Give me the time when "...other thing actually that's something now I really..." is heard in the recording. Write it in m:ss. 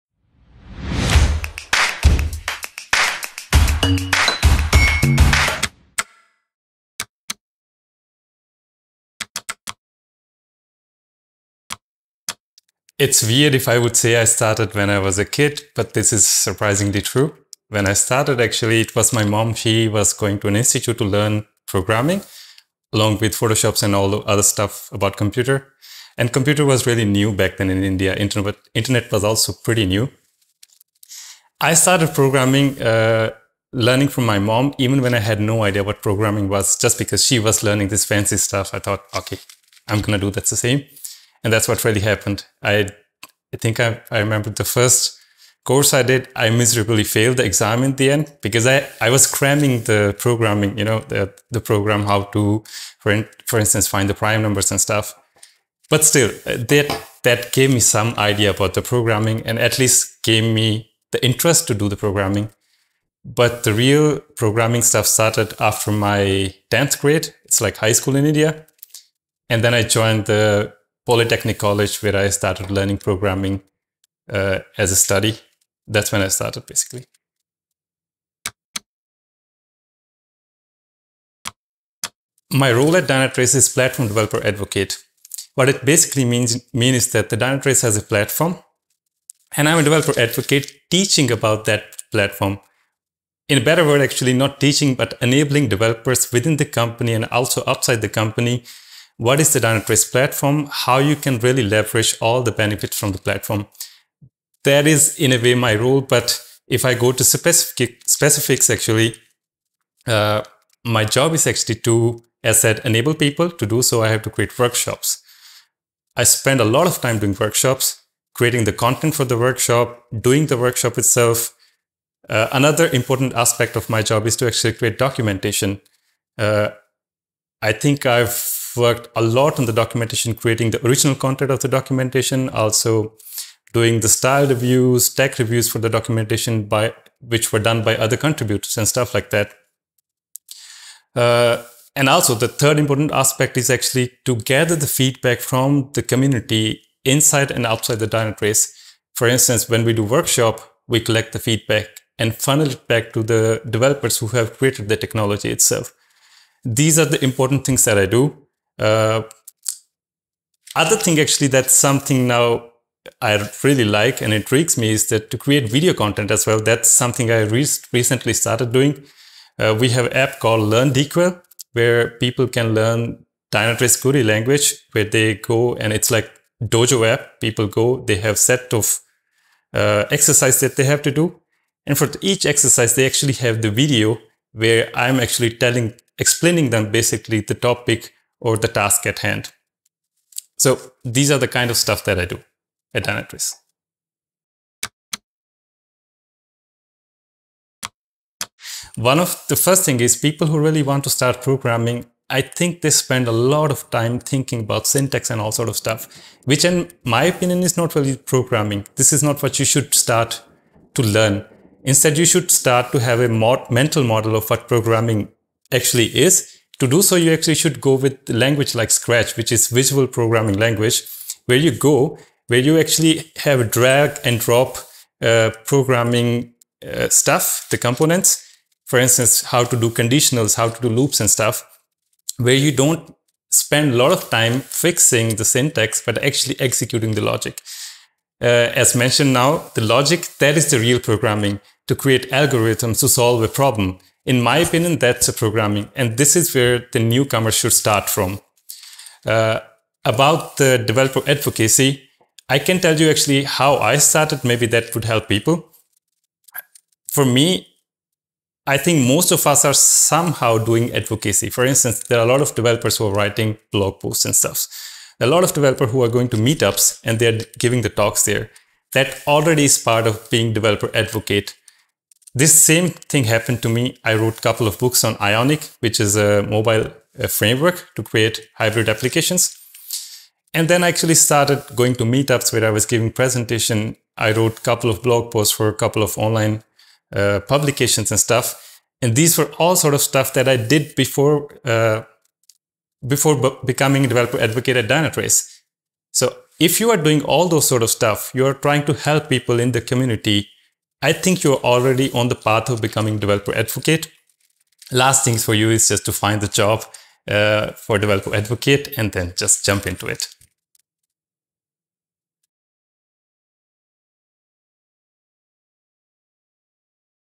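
2:40.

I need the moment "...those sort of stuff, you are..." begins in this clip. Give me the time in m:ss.
4:57.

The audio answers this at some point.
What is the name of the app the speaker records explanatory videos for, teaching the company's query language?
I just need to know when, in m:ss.
2:50.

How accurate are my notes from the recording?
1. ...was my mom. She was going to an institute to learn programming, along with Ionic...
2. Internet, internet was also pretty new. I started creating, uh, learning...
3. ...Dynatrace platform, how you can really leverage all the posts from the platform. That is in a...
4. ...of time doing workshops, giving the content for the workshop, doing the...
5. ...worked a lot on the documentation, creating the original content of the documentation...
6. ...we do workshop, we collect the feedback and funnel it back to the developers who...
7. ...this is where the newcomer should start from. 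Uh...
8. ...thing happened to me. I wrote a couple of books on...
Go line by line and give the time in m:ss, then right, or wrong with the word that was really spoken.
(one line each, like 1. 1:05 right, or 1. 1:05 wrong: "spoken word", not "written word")
1. 0:18 wrong: "Photoshops", not "Ionic"
2. 0:28 wrong: "programming", not "creating"
3. 1:39 wrong: "benefits", not "posts"
4. 1:56 wrong: "creating", not "giving"
5. 2:08 right
6. 2:29 right
7. 4:06 right
8. 4:32 right.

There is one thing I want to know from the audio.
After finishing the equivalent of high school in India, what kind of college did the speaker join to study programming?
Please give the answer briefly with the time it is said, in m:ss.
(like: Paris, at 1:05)
Polytechnic College, at 1:11.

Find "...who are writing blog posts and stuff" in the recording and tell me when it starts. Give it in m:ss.
4:22.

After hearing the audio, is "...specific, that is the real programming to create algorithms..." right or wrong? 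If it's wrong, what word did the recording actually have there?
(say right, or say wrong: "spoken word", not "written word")
wrong: "logic", not "specific".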